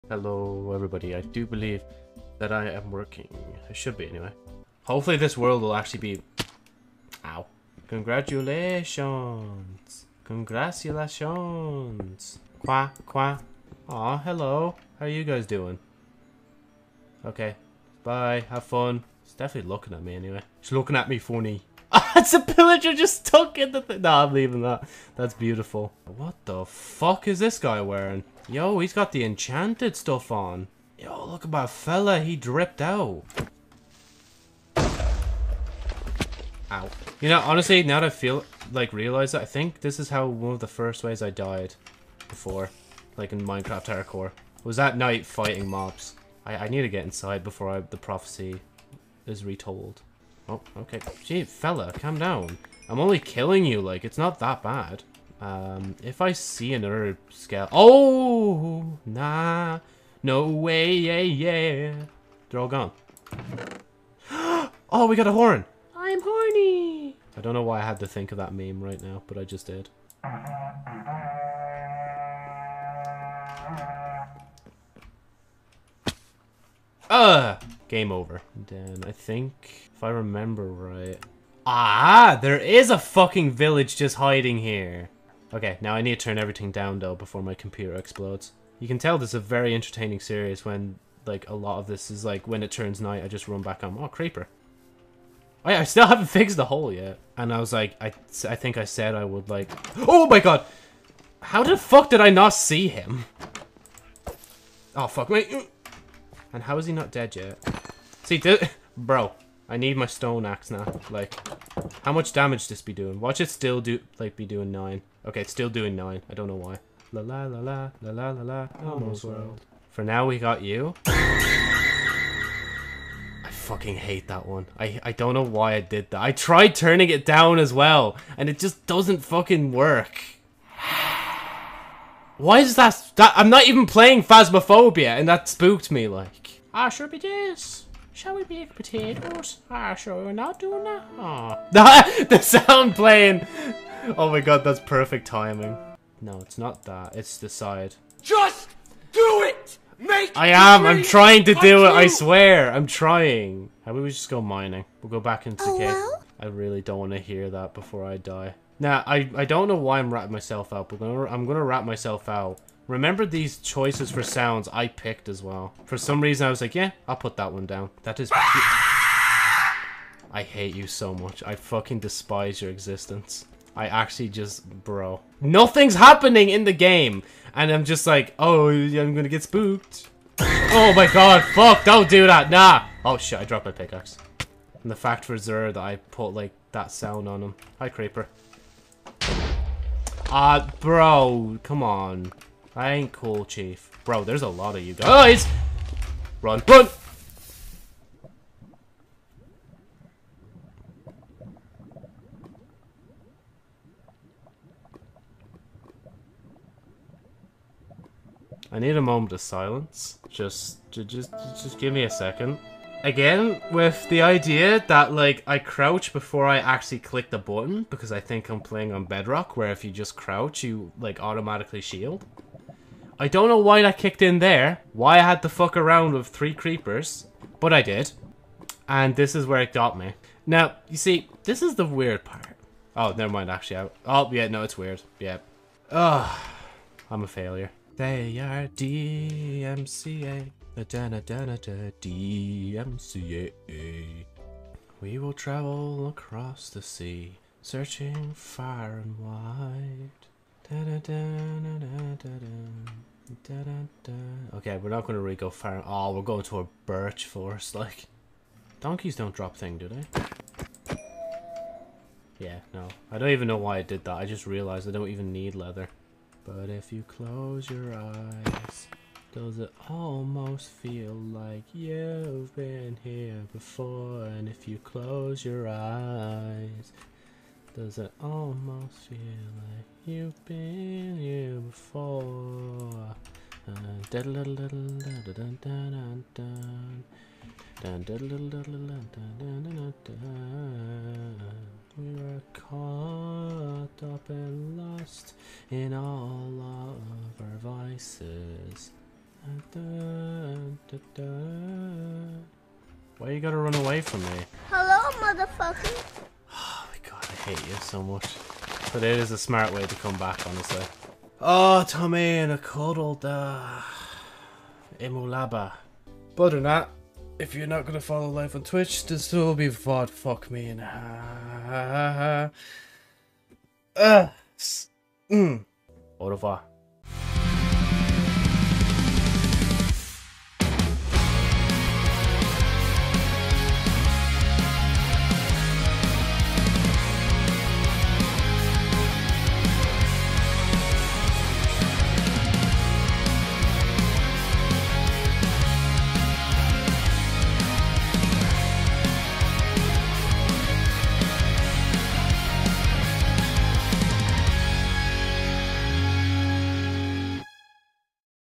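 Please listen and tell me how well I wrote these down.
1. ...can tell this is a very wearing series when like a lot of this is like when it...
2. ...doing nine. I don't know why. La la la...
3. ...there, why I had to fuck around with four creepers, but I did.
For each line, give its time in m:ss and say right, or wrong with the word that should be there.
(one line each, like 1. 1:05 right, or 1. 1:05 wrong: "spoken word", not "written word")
1. 1:28 wrong: "entertaining", not "wearing"
2. 1:55 right
3. 3:44 wrong: "three", not "four".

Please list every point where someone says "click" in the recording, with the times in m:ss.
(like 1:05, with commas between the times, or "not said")
3:36.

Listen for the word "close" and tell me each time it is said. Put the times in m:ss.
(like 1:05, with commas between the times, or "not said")
4:27, 4:34.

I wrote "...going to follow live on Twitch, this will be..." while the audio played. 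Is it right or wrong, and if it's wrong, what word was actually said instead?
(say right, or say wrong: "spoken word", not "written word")
right.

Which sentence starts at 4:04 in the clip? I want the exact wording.
We will travel across the sea, searching far and wide.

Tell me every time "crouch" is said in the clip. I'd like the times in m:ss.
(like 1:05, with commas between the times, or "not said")
3:35, 3:40.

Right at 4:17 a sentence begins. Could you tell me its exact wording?
Like, donkeys don't drop thing, do they?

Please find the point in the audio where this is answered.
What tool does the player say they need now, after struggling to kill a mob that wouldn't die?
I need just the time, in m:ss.
1:50.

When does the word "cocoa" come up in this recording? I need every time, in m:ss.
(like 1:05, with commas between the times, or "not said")
not said.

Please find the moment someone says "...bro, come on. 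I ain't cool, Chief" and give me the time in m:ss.
3:10.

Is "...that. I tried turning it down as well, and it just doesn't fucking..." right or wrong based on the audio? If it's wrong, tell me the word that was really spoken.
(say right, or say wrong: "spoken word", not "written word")
right.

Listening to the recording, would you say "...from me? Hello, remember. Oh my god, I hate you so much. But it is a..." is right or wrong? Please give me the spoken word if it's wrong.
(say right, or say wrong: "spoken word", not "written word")
wrong: "motherfucker", not "remember".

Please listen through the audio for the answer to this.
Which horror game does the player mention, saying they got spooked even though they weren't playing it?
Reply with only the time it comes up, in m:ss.
2:14.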